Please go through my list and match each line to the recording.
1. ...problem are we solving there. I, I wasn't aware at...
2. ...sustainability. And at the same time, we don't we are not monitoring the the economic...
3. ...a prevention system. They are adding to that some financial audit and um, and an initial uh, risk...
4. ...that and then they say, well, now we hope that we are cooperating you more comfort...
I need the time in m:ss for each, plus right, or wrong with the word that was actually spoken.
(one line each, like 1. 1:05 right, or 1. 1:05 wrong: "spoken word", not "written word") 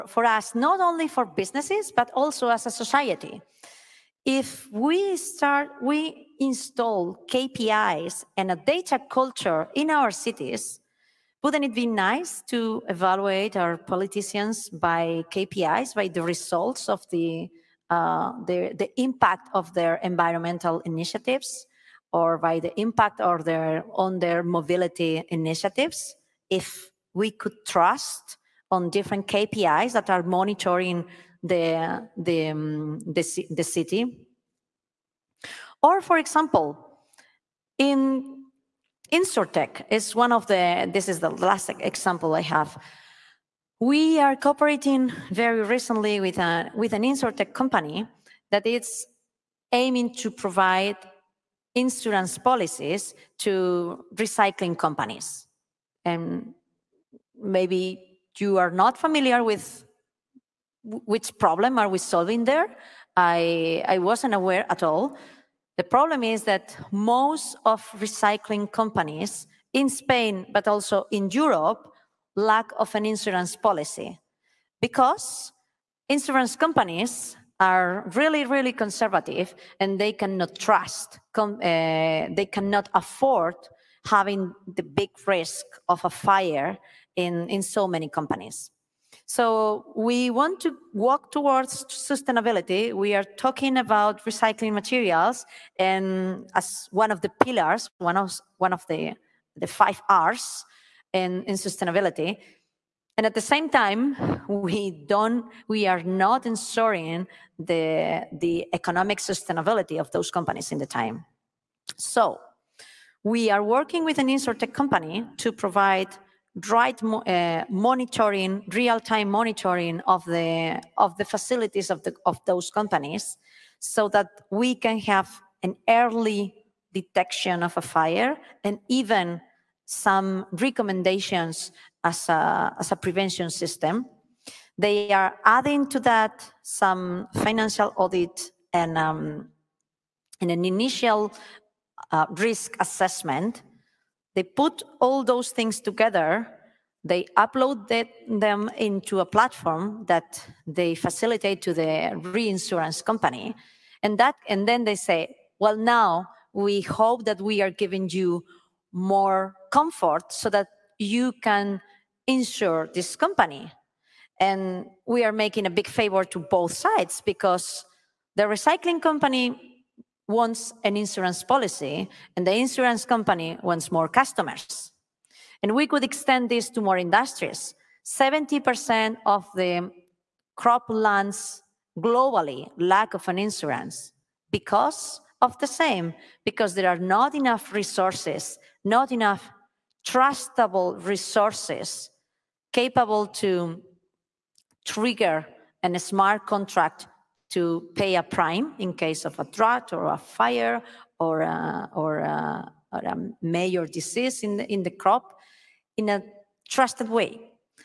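1. 1:01 right
2. 1:41 wrong: "ensuring", not "monitoring"
3. 2:12 right
4. 2:34 wrong: "giving", not "cooperating".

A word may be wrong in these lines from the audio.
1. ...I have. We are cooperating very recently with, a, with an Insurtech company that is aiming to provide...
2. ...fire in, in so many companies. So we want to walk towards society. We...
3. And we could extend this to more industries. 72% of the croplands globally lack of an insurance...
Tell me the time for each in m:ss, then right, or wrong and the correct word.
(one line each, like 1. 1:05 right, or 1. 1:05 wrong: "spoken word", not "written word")
1. 0:42 right
2. 1:26 wrong: "sustainability", not "society"
3. 2:55 wrong: "70", not "72".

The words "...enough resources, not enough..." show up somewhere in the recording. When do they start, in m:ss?
3:07.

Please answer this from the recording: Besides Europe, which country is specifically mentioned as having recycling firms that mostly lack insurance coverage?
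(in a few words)
Spain.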